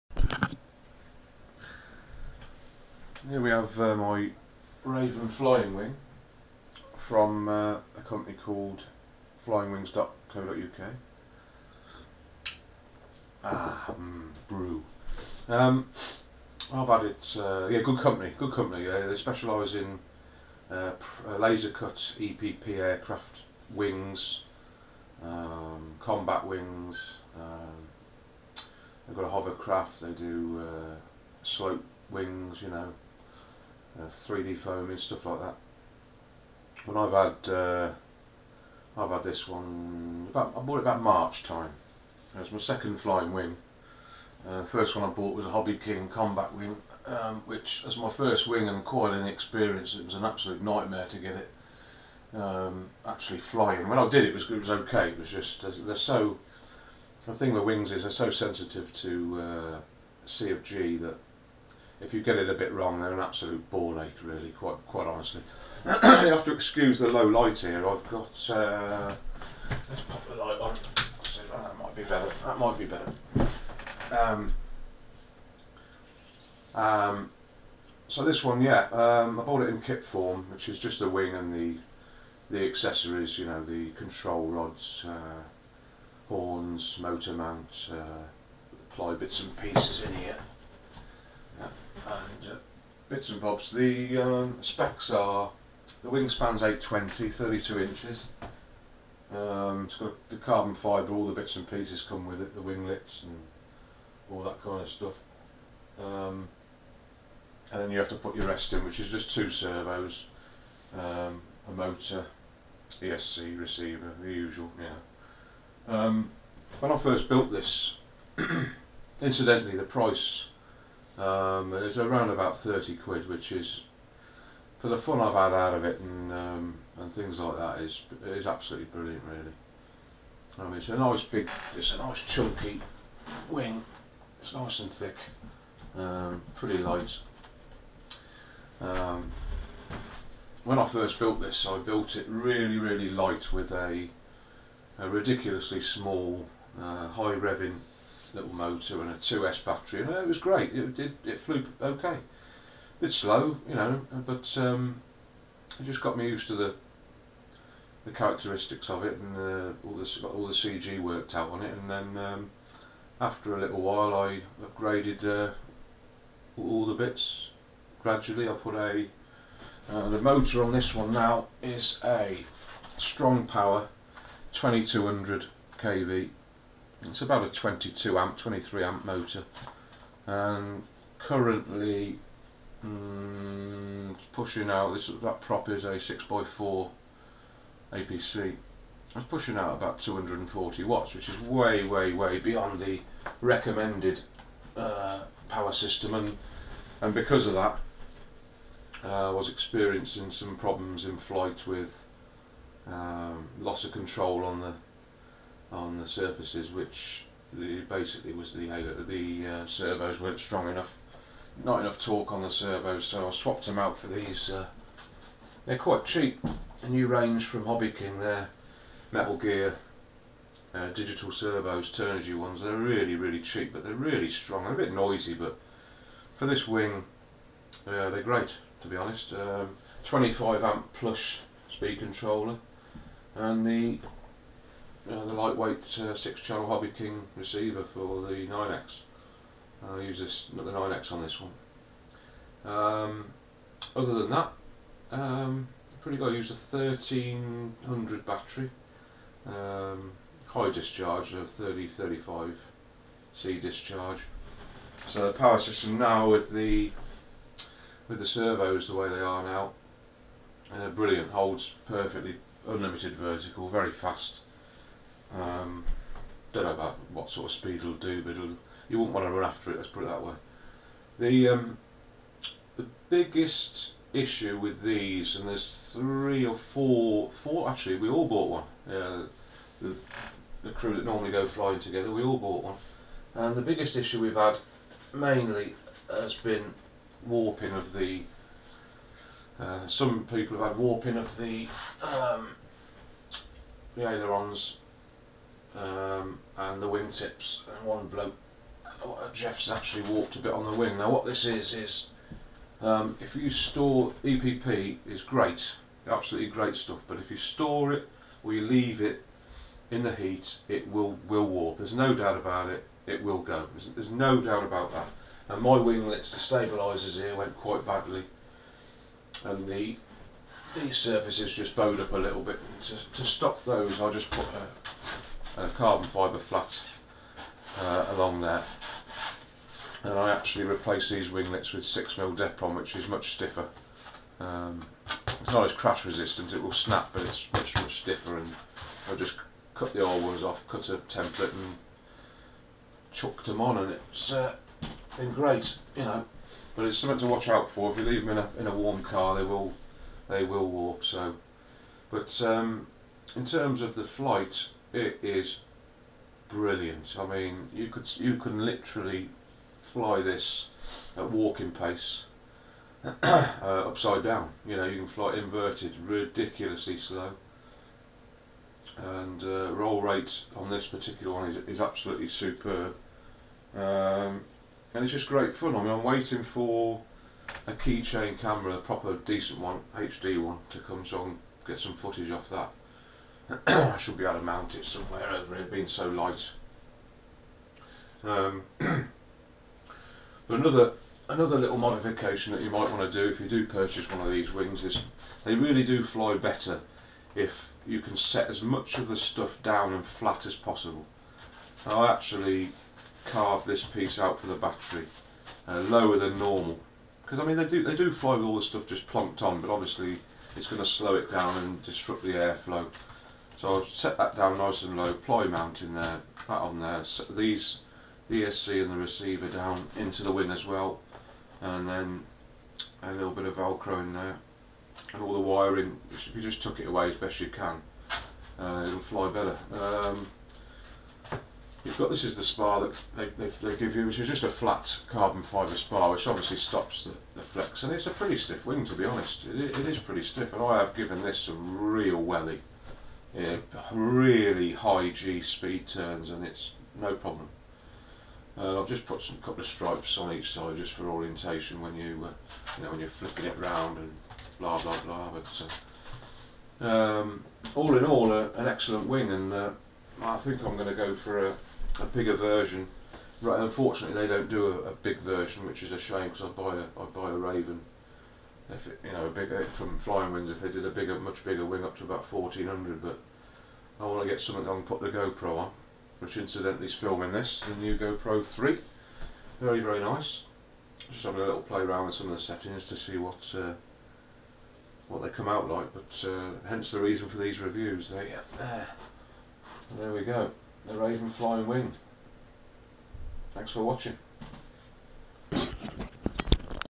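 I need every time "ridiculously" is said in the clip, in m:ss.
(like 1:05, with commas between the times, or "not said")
2:25, 6:06.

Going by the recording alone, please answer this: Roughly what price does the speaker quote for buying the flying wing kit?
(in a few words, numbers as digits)
£30.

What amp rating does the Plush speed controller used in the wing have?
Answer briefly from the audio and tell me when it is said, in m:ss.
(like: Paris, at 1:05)
25 amp, at 3:50.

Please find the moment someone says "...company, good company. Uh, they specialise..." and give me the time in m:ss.
0:17.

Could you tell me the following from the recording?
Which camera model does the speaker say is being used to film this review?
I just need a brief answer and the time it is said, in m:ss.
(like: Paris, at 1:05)
GoPro 3, at 7:57.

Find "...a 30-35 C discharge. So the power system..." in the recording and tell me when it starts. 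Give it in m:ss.
4:11.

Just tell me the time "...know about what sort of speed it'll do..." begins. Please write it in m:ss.
4:26.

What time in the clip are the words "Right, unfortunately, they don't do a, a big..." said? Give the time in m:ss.
7:43.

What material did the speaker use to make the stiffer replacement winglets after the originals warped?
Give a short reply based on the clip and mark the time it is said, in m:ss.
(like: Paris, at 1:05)
6mm Depron, at 5:31.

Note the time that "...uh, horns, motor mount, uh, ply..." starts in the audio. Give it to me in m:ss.
1:25.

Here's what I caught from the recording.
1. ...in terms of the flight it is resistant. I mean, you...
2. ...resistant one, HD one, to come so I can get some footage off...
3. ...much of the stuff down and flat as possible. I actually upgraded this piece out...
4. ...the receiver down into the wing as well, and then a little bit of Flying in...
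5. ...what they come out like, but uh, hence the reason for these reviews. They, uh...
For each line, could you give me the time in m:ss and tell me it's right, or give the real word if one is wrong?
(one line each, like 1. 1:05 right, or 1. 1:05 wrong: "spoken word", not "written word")
1. 5:53 wrong: "brilliant", not "resistant"
2. 6:19 wrong: "decent", not "resistant"
3. 6:38 wrong: "carved", not "upgraded"
4. 6:58 wrong: "Velcro", not "Flying"
5. 8:05 right.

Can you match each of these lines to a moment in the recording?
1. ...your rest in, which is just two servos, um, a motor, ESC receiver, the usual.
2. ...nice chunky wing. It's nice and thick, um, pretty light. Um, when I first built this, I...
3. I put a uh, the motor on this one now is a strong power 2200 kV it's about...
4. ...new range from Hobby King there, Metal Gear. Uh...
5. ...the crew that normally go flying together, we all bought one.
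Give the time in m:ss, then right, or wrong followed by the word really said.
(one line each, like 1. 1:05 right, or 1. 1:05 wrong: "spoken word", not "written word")
1. 1:48 right
2. 2:11 right
3. 2:48 right
4. 3:36 right
5. 4:40 right.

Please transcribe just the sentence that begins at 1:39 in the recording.
Um, it's got the carbon fibre, all the bits and pieces come with it, the winglets and all that kind of stuff.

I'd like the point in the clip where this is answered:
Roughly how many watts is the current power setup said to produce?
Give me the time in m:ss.
3:09.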